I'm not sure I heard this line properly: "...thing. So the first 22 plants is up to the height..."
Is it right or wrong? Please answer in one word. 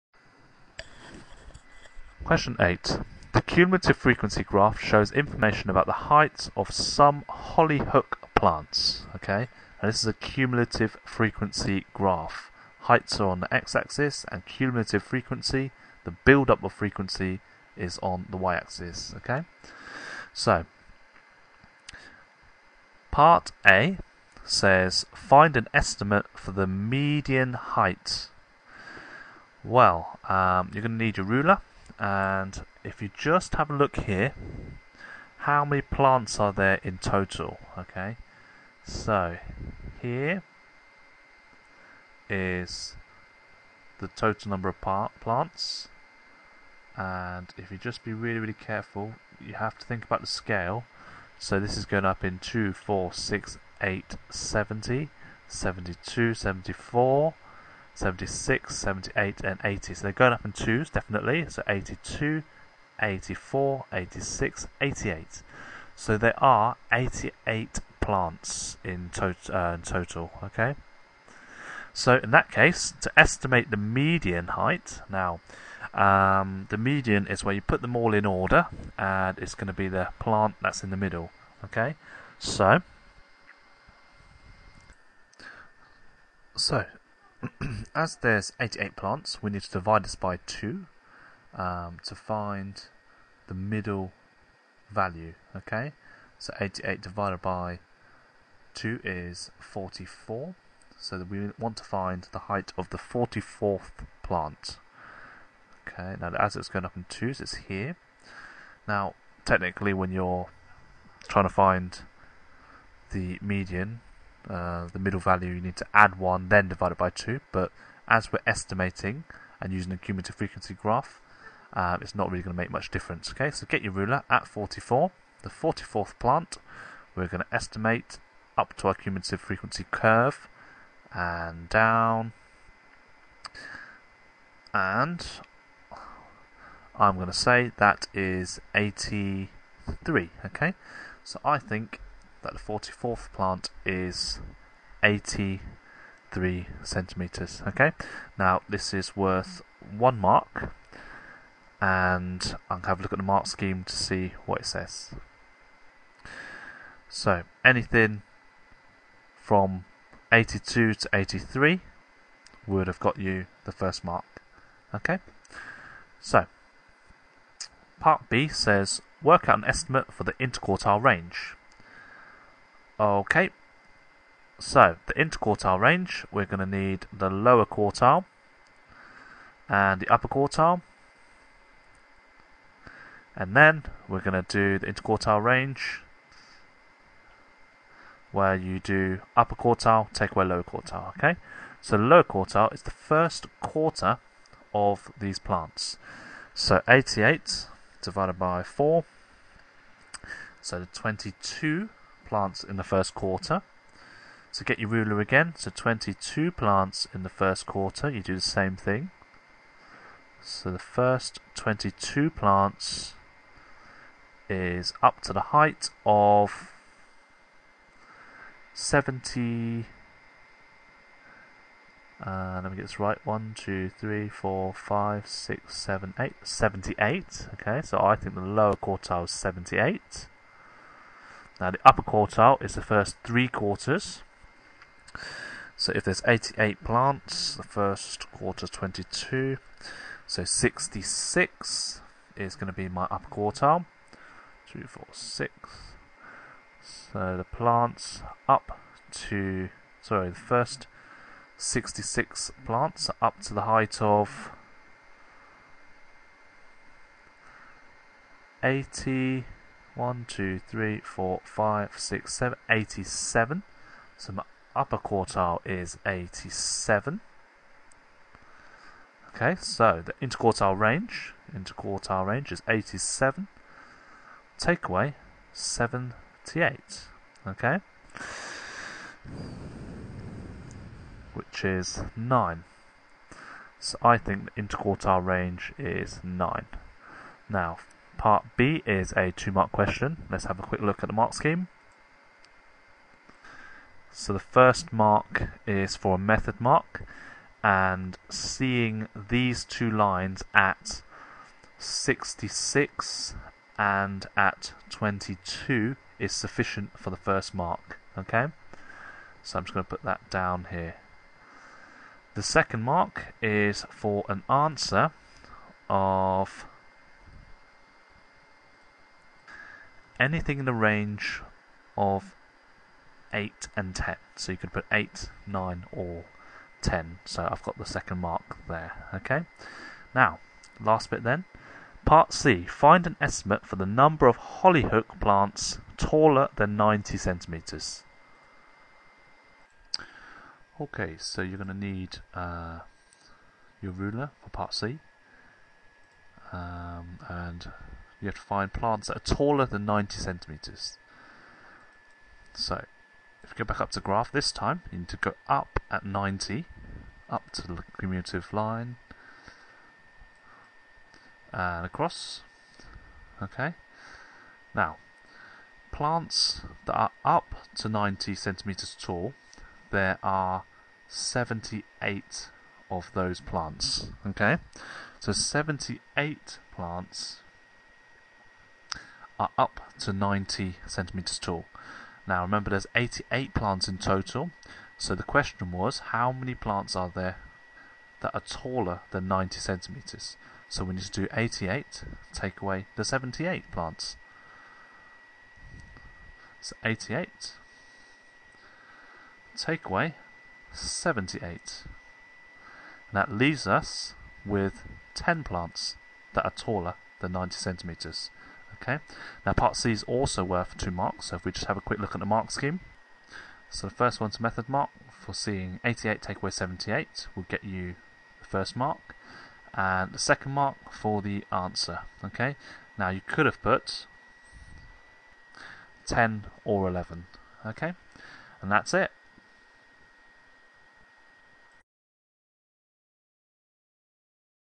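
right.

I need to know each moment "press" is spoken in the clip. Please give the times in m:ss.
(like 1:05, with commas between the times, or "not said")
not said.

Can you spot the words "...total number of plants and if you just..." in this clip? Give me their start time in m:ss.
0:44.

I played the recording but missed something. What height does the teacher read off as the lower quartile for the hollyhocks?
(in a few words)
78.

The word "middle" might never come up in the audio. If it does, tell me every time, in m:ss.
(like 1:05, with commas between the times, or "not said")
1:20, 1:33, 1:54.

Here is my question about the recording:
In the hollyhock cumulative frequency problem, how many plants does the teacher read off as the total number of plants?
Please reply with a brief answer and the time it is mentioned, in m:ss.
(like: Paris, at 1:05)
88, at 1:05.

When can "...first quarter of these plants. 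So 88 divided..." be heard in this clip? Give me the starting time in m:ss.
3:12.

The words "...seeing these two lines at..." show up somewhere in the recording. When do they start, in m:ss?
4:58.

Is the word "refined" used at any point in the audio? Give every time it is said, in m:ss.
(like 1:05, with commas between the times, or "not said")
not said.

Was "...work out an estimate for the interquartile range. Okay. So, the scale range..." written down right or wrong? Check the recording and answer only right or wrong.
wrong.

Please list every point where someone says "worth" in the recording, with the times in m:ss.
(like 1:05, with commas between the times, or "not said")
2:29, 6:50.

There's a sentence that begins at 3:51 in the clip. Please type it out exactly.
Now the upper quartile is the first three quarters.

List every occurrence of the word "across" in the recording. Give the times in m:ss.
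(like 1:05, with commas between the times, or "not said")
6:01.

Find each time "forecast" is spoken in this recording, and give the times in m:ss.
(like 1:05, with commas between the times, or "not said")
not said.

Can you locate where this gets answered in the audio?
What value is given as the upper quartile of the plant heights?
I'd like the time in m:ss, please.
4:24.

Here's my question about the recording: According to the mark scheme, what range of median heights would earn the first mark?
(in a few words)
82 to 83.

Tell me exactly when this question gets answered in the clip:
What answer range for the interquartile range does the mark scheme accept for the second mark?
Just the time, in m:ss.
5:23.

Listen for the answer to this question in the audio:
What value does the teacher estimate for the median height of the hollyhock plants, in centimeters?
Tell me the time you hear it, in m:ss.
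2:22.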